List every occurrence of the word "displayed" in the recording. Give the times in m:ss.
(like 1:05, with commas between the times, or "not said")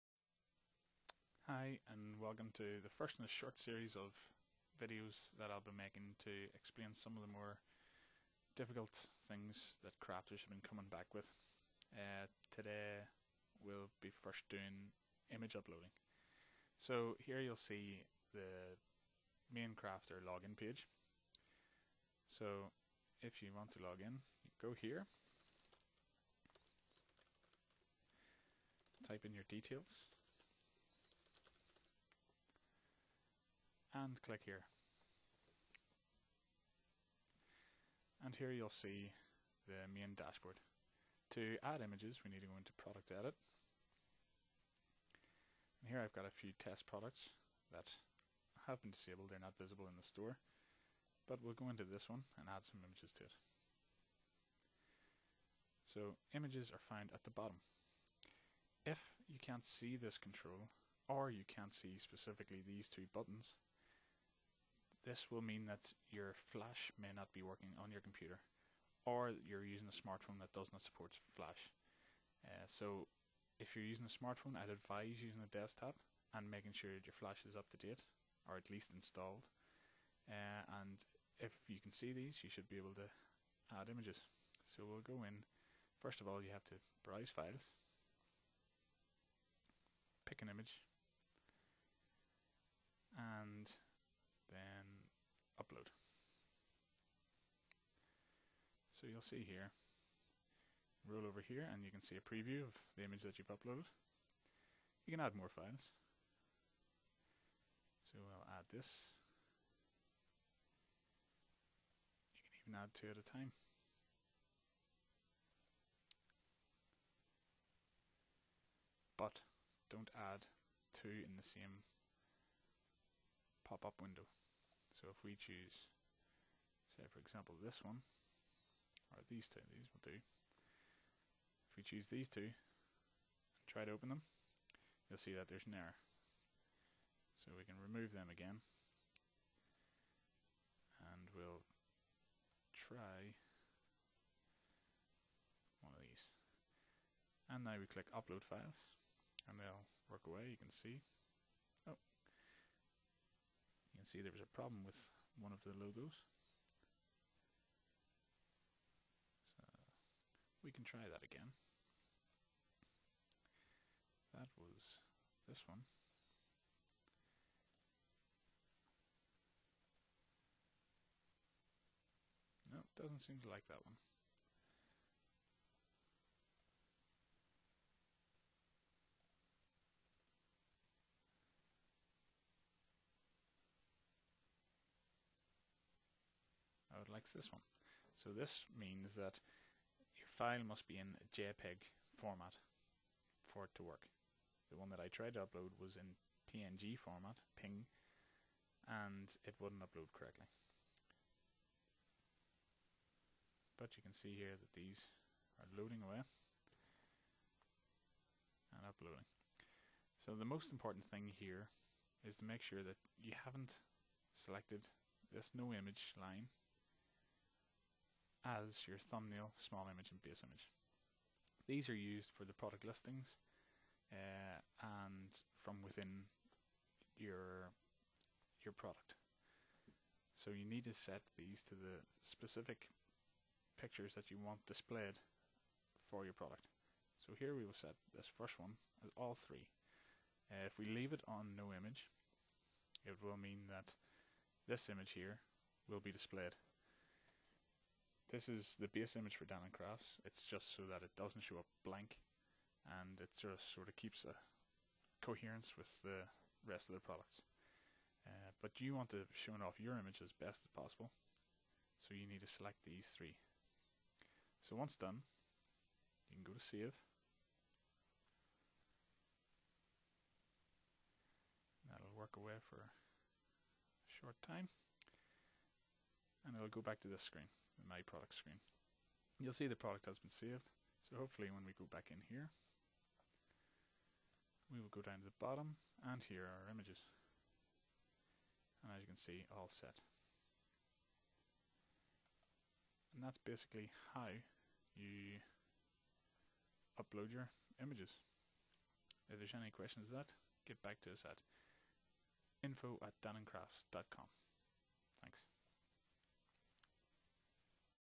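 3:54, 4:06.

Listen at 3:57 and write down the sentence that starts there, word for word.
So here we will set this first one as all three.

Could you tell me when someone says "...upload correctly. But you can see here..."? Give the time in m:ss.
3:19.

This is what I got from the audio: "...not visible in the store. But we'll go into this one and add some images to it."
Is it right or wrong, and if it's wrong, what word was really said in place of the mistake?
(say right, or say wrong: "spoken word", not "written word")
right.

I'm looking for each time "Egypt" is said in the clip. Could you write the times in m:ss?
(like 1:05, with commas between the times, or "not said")
not said.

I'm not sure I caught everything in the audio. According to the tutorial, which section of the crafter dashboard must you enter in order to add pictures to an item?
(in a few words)
Product Edit.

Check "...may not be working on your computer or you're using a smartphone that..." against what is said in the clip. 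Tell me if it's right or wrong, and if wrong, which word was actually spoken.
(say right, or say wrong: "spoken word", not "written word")
right.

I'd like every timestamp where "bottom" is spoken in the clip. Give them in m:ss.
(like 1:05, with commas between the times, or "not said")
0:57, 4:45.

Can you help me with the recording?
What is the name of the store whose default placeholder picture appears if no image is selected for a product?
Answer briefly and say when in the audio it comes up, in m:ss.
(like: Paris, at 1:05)
Danann Crafts, at 4:09.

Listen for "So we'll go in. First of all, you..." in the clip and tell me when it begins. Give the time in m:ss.
1:24.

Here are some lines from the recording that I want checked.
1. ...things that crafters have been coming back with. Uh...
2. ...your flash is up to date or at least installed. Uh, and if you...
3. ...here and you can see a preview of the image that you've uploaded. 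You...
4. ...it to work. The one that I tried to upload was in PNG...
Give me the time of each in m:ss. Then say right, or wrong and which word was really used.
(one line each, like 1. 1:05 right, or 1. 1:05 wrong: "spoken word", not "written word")
1. 0:09 right
2. 1:17 right
3. 1:41 right
4. 3:13 right.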